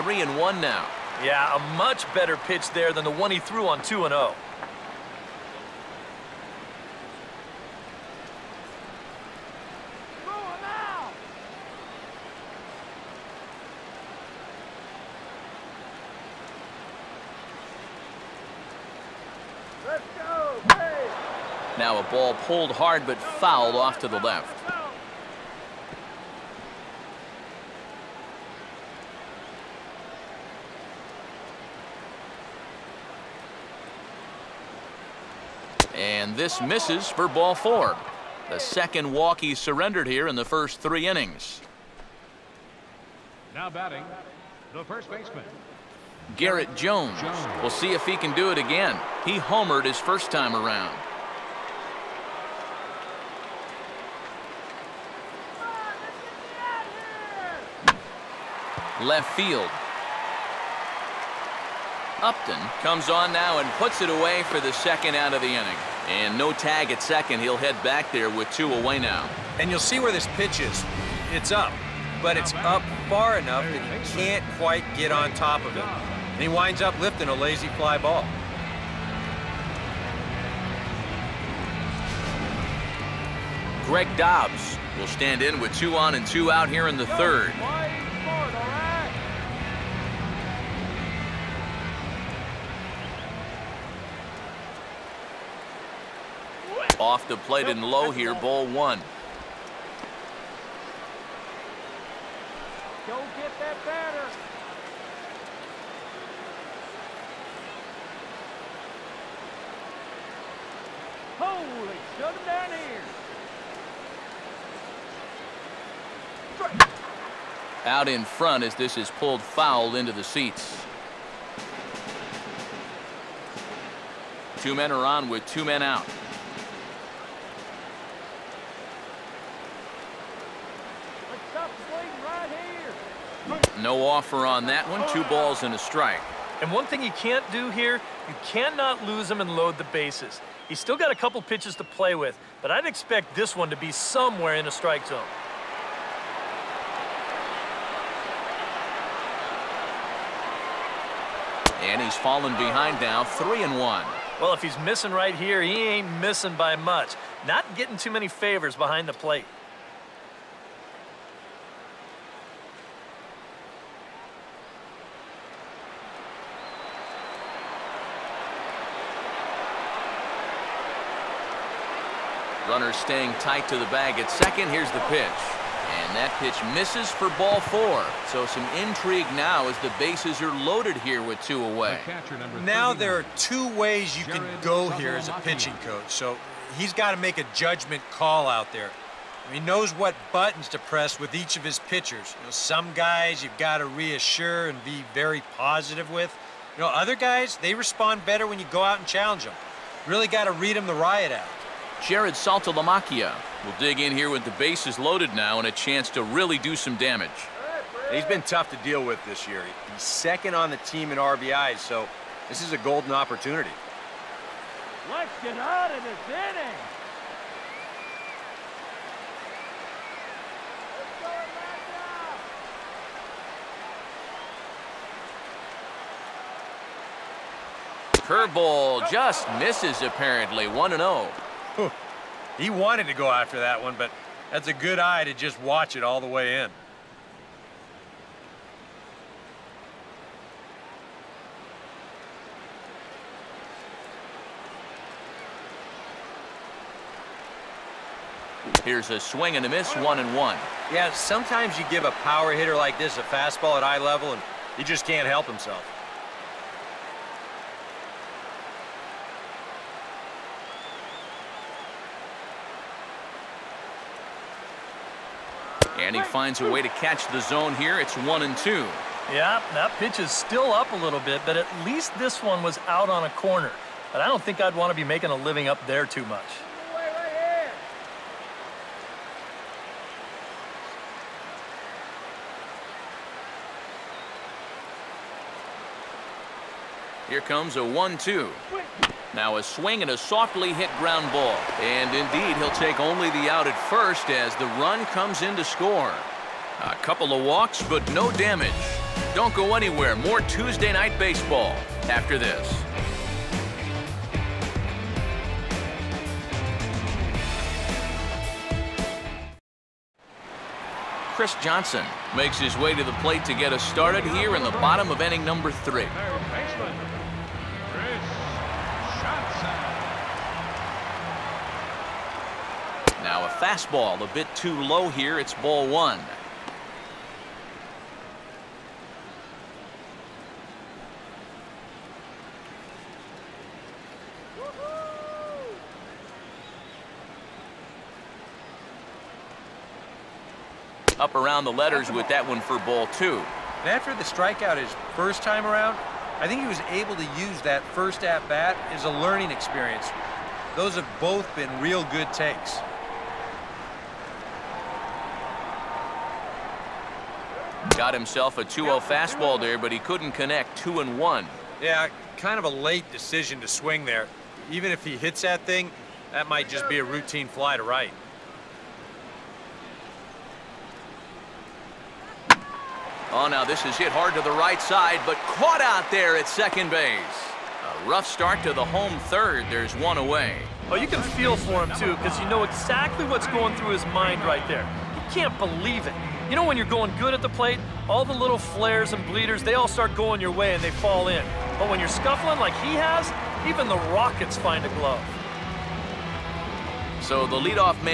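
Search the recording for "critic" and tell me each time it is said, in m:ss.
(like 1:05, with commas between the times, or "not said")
not said.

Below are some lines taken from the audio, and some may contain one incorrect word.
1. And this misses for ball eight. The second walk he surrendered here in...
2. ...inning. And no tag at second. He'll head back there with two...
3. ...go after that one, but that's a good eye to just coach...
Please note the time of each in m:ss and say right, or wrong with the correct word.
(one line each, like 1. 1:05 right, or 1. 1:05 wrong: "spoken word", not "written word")
1. 0:35 wrong: "four", not "eight"
2. 1:05 right
3. 3:53 wrong: "watch", not "coach".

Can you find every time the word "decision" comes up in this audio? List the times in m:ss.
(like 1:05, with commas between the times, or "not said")
6:03.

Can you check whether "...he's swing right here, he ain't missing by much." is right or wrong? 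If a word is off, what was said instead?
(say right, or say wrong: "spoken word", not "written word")
wrong: "missing", not "swing".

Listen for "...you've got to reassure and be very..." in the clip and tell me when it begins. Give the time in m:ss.
3:13.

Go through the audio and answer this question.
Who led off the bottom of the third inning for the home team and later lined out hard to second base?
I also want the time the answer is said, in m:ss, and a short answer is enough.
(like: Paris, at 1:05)
Chris Johnson, at 5:11.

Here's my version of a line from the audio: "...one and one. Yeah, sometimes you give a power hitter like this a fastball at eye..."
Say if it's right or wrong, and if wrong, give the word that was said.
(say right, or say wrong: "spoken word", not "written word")
right.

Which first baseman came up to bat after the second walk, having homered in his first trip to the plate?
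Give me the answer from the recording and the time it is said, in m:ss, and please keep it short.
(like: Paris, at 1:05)
Garrett Jones, at 0:46.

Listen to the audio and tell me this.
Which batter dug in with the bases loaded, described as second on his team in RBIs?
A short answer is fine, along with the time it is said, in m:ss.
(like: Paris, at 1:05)
Jarrod Saltalamacchia, at 3:22.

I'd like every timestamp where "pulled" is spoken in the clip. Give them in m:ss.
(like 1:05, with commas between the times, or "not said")
0:22, 1:59.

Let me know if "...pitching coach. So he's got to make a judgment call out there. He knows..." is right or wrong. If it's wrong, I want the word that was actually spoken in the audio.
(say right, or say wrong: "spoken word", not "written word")
right.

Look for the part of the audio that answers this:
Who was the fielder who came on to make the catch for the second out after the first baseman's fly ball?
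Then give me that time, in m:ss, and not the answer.
1:02.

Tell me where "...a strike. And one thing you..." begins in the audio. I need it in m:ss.
2:15.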